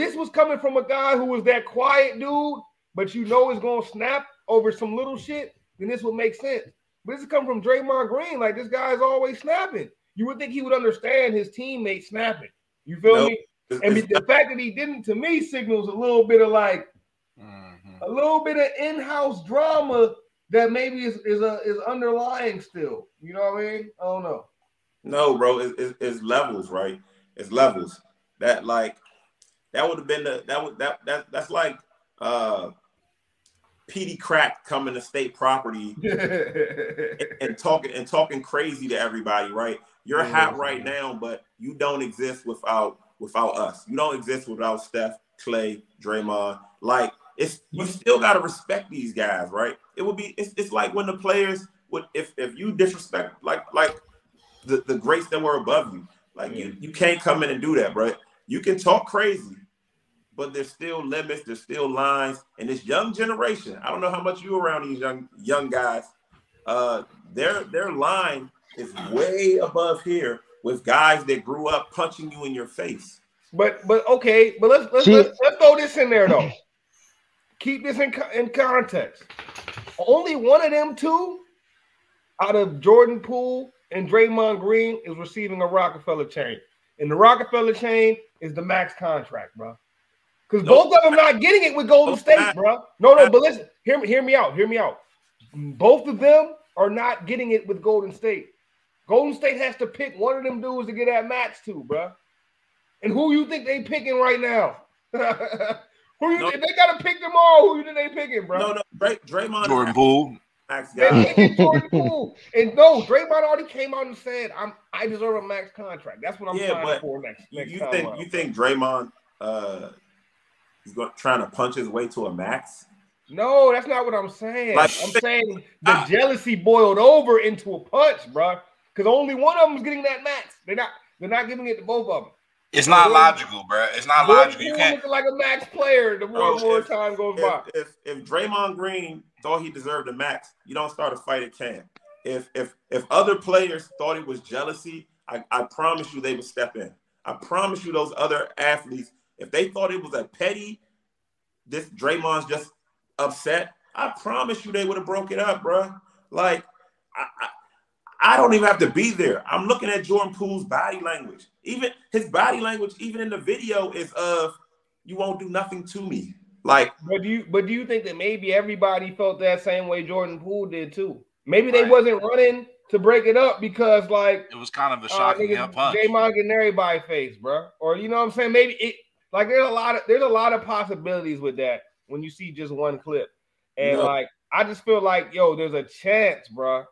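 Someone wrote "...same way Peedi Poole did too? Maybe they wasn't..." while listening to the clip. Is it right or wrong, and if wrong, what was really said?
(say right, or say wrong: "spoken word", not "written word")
wrong: "Jordan", not "Peedi".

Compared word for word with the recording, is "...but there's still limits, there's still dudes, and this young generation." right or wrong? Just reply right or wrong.
wrong.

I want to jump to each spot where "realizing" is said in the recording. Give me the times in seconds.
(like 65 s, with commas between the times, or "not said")
not said.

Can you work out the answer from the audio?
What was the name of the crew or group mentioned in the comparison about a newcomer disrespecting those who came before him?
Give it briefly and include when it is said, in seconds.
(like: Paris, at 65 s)
State Property, at 35 s.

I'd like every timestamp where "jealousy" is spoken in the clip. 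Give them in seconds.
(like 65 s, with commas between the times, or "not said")
126 s, 144 s.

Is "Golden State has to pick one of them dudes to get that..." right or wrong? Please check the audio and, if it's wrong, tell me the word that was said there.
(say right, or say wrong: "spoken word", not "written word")
right.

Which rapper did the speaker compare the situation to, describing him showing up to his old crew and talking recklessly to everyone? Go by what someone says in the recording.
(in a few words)
Peedi Crakk.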